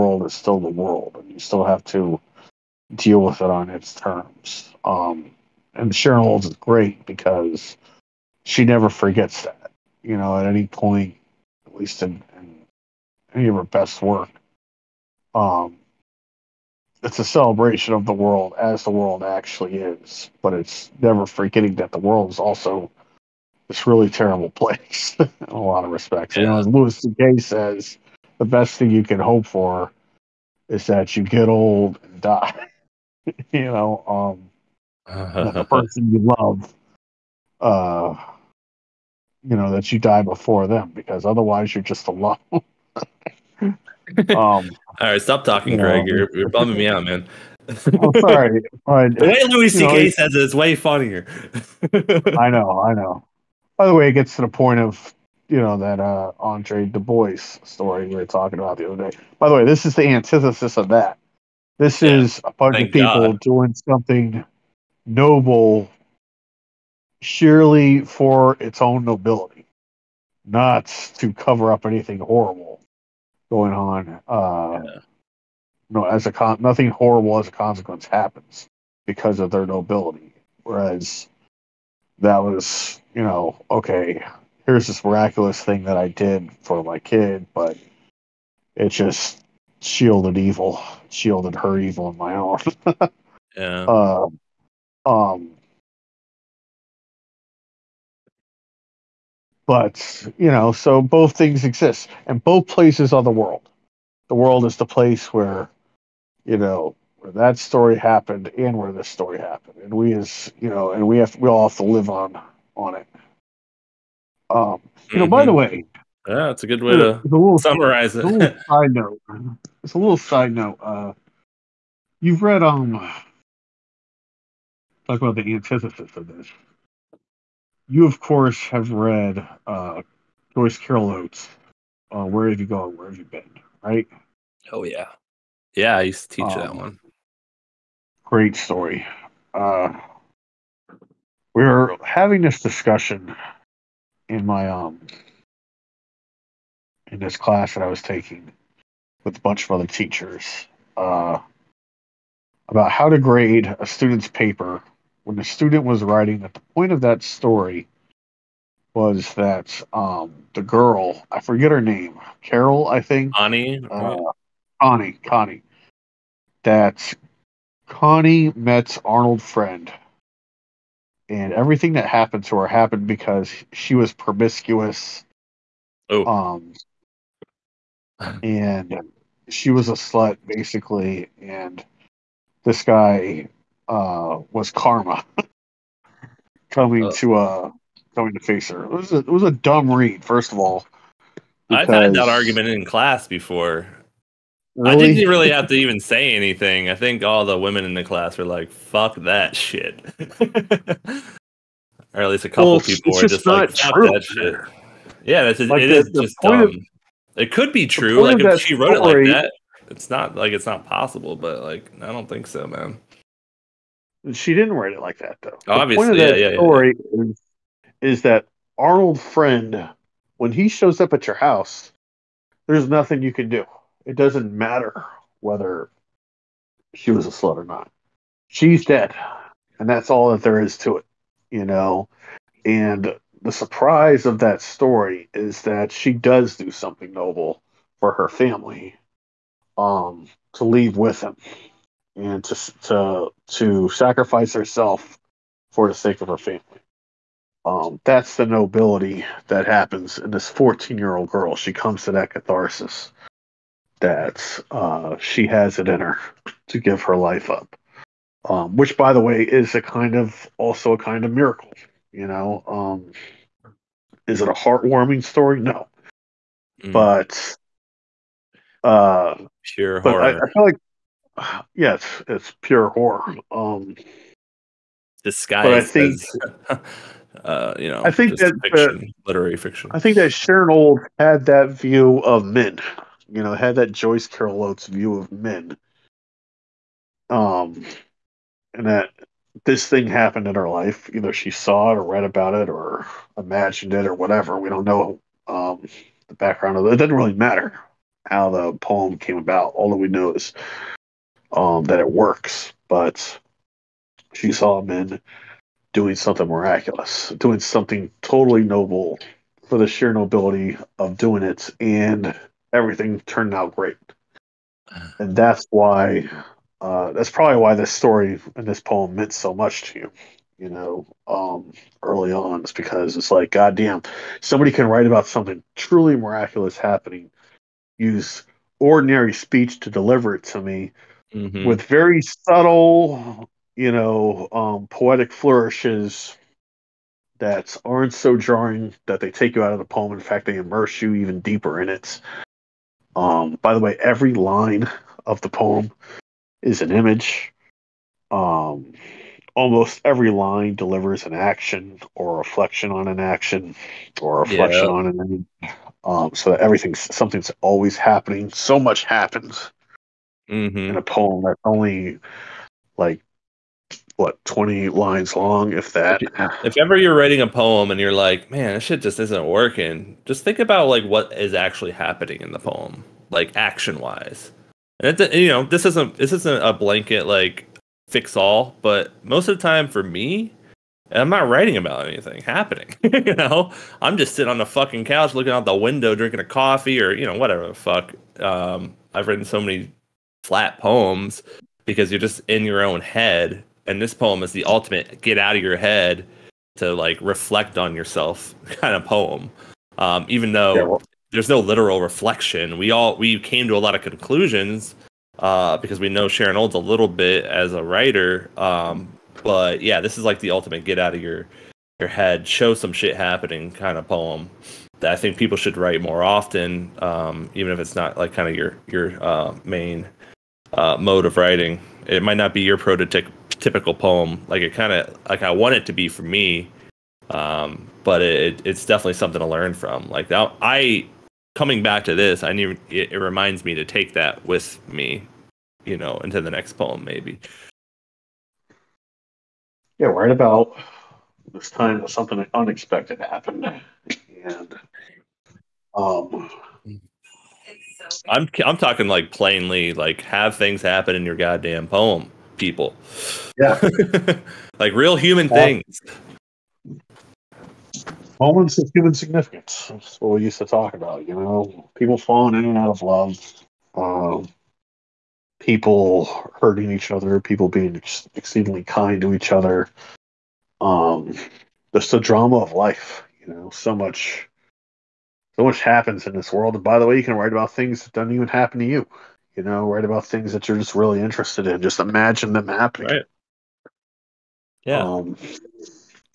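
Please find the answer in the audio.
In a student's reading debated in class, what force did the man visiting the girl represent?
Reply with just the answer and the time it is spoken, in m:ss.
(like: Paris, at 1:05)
Karma, at 3:04.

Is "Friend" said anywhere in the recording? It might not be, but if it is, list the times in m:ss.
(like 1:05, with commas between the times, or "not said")
2:49, 3:39.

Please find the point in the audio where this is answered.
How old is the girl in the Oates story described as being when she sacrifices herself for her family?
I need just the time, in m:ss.
4:10.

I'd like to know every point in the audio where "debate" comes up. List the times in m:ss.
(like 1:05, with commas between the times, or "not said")
not said.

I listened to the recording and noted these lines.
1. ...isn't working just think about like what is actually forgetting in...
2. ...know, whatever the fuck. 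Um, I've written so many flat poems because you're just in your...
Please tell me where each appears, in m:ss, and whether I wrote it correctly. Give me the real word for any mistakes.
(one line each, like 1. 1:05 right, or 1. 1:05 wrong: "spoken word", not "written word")
1. 6:09 wrong: "happening", not "forgetting"
2. 6:27 right.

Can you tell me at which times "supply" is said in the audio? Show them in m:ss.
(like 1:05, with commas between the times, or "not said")
not said.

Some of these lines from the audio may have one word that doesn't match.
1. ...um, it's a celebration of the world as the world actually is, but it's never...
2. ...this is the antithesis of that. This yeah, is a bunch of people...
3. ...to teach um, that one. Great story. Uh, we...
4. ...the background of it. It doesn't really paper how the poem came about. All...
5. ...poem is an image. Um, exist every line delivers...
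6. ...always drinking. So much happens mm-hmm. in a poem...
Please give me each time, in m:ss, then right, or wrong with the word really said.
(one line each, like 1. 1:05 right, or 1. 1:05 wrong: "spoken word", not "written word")
1. 0:15 right
2. 0:59 right
3. 2:16 right
4. 4:56 wrong: "matter", not "paper"
5. 5:45 wrong: "almost", not "exist"
6. 5:57 wrong: "happening", not "drinking".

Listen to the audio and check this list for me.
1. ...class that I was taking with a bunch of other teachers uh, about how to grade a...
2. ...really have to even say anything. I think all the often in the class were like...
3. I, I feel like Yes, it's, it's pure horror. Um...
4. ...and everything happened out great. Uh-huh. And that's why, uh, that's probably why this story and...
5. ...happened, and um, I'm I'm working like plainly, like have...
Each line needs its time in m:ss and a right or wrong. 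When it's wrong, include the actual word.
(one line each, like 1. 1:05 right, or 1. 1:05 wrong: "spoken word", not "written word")
1. 2:27 right
2. 3:15 wrong: "women", not "often"
3. 4:30 right
4. 5:11 wrong: "turned", not "happened"
5. 7:23 wrong: "talking", not "working".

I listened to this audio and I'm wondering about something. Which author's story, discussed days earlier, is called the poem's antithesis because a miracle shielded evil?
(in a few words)
Andre Dubus.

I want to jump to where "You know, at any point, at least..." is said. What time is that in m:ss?
0:10.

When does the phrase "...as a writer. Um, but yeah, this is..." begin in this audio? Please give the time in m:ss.
6:47.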